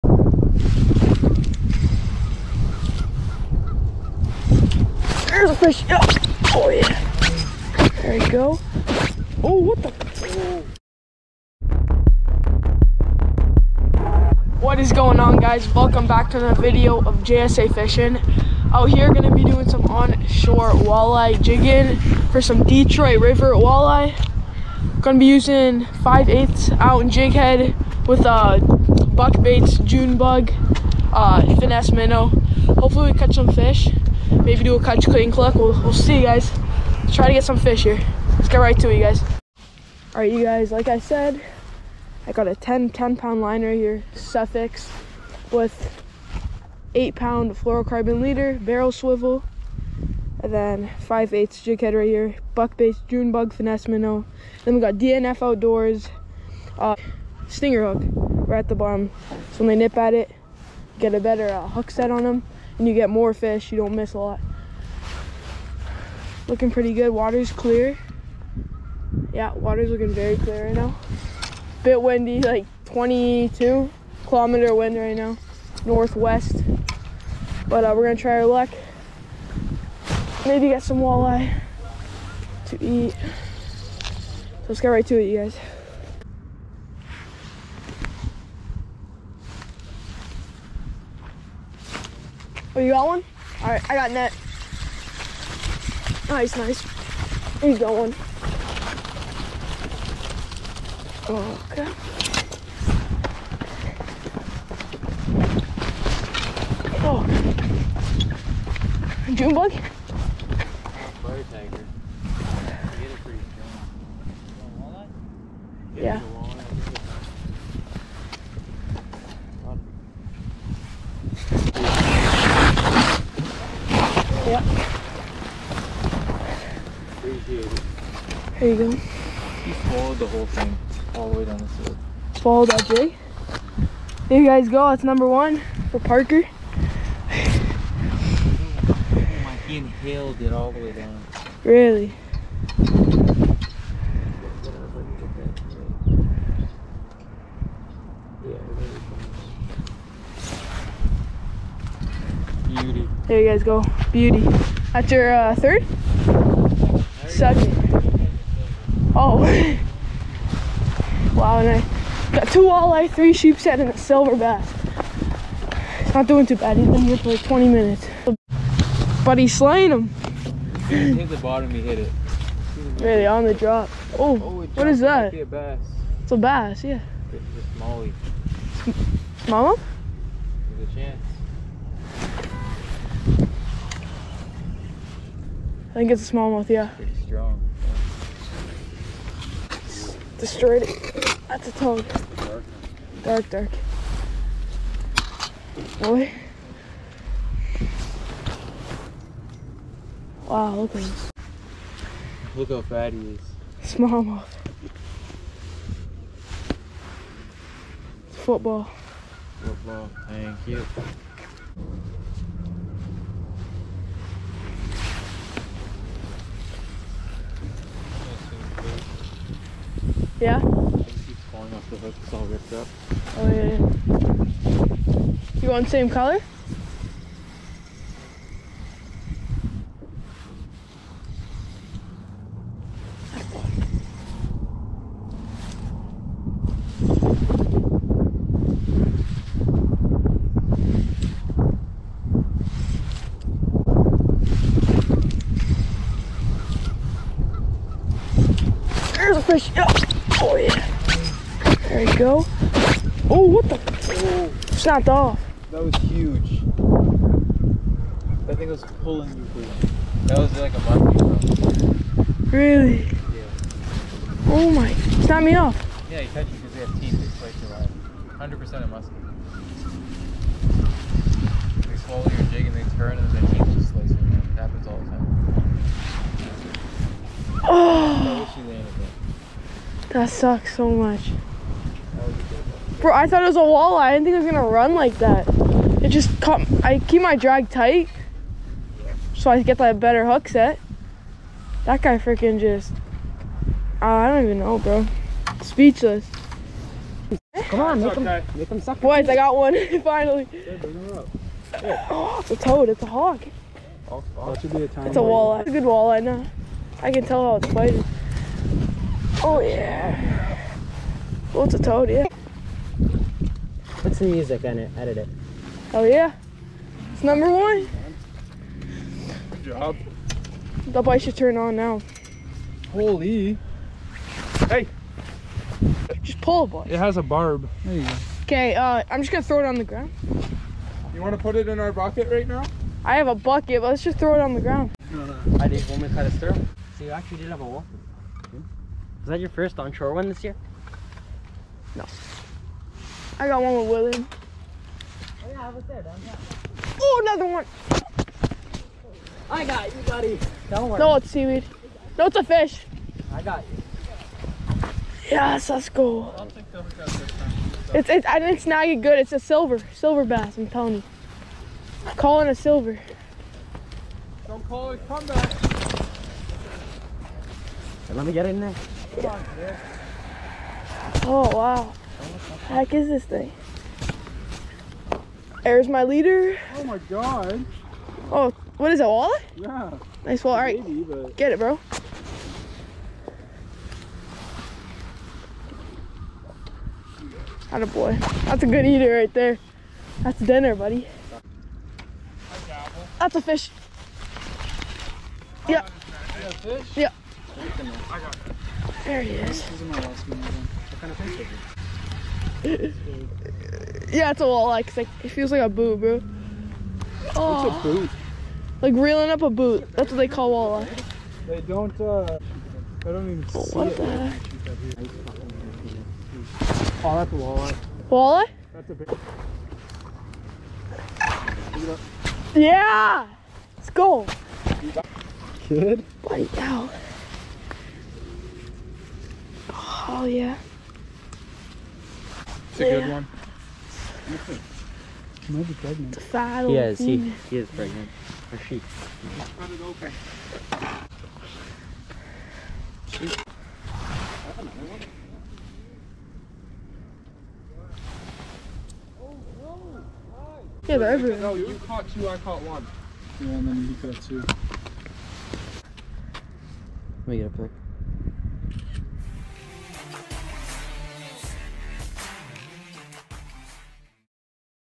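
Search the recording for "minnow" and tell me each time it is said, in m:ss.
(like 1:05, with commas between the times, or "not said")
0:31, 0:53.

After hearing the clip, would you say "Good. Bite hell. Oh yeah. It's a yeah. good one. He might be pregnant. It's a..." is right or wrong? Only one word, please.
right.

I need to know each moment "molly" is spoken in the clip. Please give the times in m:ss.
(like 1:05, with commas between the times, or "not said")
2:57.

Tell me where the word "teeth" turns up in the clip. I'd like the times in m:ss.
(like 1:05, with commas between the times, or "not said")
4:26, 4:33.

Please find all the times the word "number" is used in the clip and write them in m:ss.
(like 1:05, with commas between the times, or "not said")
2:15, 5:17.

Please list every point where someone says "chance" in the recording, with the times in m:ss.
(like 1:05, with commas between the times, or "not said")
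3:00.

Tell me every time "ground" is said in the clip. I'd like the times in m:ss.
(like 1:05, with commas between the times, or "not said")
5:29, 5:34.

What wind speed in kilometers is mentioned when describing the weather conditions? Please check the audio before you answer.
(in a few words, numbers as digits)
22.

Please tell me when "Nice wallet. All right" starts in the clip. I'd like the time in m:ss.
6:20.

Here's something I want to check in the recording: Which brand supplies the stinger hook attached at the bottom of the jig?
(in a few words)
DNF Outdoors.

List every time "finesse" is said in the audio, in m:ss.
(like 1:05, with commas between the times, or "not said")
0:31, 0:53.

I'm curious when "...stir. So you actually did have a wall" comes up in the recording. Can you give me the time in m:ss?
5:36.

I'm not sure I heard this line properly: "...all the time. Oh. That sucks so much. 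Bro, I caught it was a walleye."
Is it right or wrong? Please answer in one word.
wrong.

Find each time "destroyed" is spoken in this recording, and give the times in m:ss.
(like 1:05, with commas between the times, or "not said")
3:10.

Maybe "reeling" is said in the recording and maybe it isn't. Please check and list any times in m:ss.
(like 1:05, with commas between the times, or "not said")
6:48.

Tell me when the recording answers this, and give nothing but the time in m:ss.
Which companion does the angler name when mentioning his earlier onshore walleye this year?
5:43.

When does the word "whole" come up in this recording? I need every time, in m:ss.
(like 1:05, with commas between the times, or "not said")
2:10.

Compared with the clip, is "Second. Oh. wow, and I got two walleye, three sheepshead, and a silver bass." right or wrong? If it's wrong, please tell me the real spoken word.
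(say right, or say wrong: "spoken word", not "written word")
right.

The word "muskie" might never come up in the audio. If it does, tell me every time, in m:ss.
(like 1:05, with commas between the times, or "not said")
4:20, 4:28.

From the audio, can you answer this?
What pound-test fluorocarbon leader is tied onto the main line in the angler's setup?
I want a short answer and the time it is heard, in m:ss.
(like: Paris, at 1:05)
8 pound, at 0:46.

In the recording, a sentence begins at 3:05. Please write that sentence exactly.
I think it's a smallmouth, yeah.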